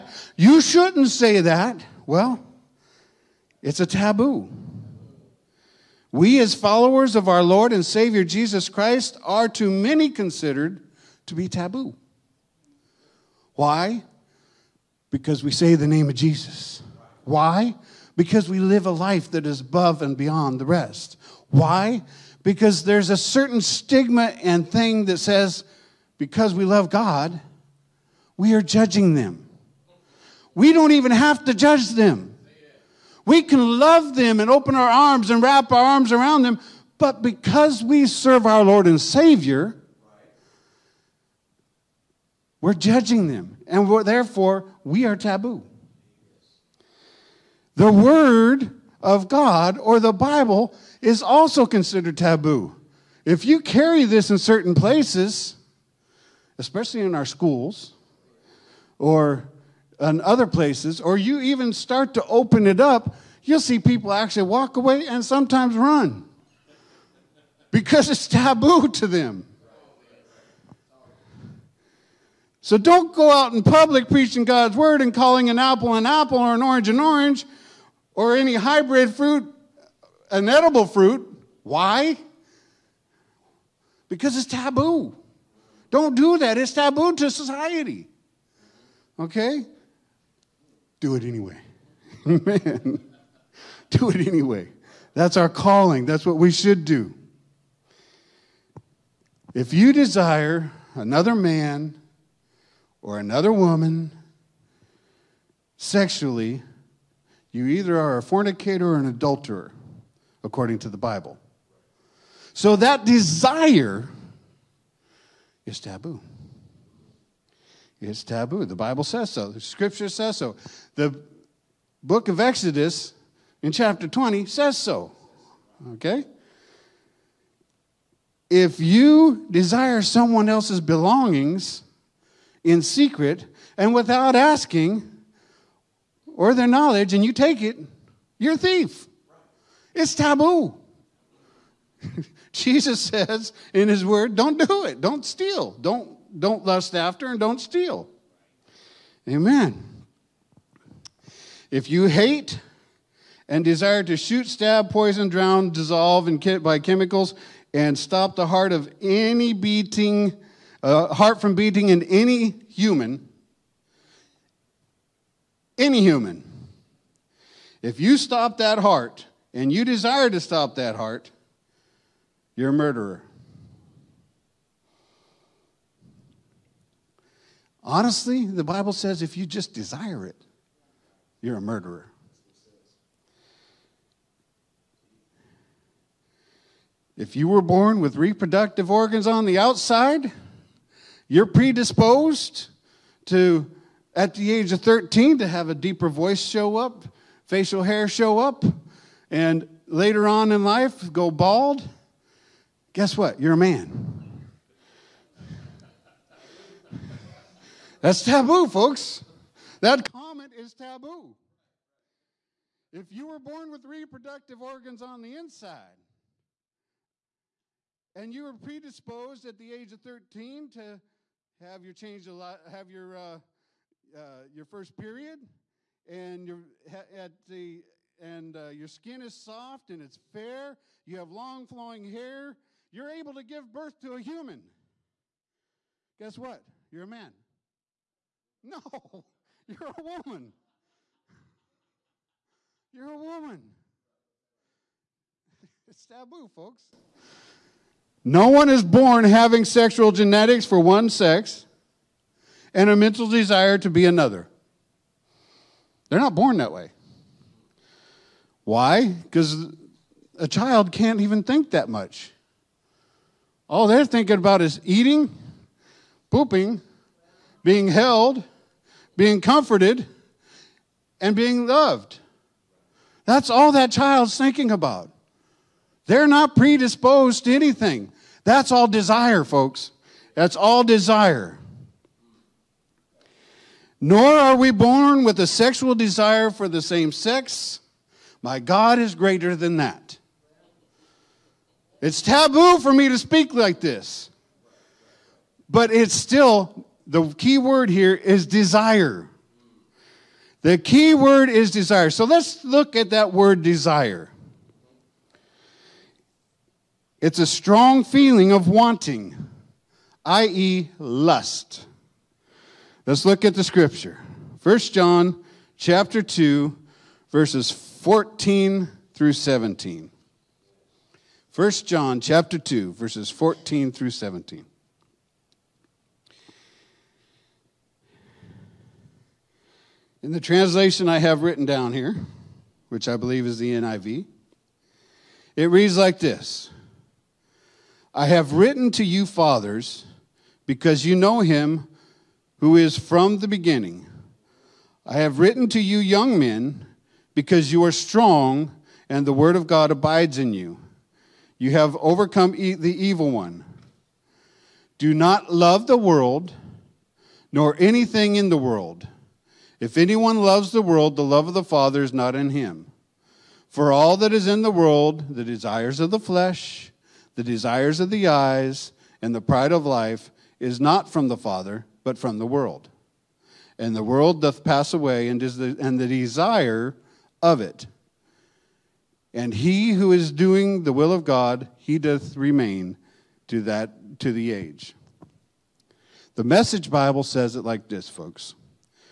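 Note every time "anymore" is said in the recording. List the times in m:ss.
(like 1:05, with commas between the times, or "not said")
not said.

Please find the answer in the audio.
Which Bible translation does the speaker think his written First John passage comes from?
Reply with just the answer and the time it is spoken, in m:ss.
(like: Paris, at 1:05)
NIV, at 5:33.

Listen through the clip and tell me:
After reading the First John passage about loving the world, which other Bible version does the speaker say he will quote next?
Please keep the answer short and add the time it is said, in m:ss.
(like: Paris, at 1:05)
The Message, at 6:26.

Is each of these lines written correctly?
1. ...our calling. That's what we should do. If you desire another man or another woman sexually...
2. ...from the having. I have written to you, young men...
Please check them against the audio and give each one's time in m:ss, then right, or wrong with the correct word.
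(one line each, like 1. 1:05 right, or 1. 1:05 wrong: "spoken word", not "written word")
1. 1:35 right
2. 5:42 wrong: "beginning", not "having".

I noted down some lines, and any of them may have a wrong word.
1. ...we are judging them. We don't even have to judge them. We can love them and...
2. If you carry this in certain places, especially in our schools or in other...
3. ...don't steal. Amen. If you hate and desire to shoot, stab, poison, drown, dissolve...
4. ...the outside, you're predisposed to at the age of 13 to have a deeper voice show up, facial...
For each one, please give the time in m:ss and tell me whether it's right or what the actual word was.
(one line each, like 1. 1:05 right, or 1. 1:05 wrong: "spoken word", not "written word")
1. 0:28 right
2. 0:53 right
3. 2:27 right
4. 3:09 right.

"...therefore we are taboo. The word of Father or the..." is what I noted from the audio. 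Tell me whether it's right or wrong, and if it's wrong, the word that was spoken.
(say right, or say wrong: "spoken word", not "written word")
wrong: "God", not "Father".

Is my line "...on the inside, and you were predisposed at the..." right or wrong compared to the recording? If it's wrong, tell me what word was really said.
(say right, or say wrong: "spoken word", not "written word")
right.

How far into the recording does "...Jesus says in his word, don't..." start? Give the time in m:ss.
2:22.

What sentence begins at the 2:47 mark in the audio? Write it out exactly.
If you stop that heart and you desire to stop that heart, you're a murderer.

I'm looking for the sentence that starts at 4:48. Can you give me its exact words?
My God is greater than that.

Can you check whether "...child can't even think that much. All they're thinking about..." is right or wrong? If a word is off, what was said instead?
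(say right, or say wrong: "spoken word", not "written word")
right.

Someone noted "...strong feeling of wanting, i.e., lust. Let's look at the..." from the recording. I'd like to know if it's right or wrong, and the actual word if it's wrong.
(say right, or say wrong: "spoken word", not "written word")
right.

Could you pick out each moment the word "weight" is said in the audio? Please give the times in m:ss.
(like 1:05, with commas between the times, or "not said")
not said.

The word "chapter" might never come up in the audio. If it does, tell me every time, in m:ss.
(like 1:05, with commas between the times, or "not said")
2:03, 5:15, 5:22.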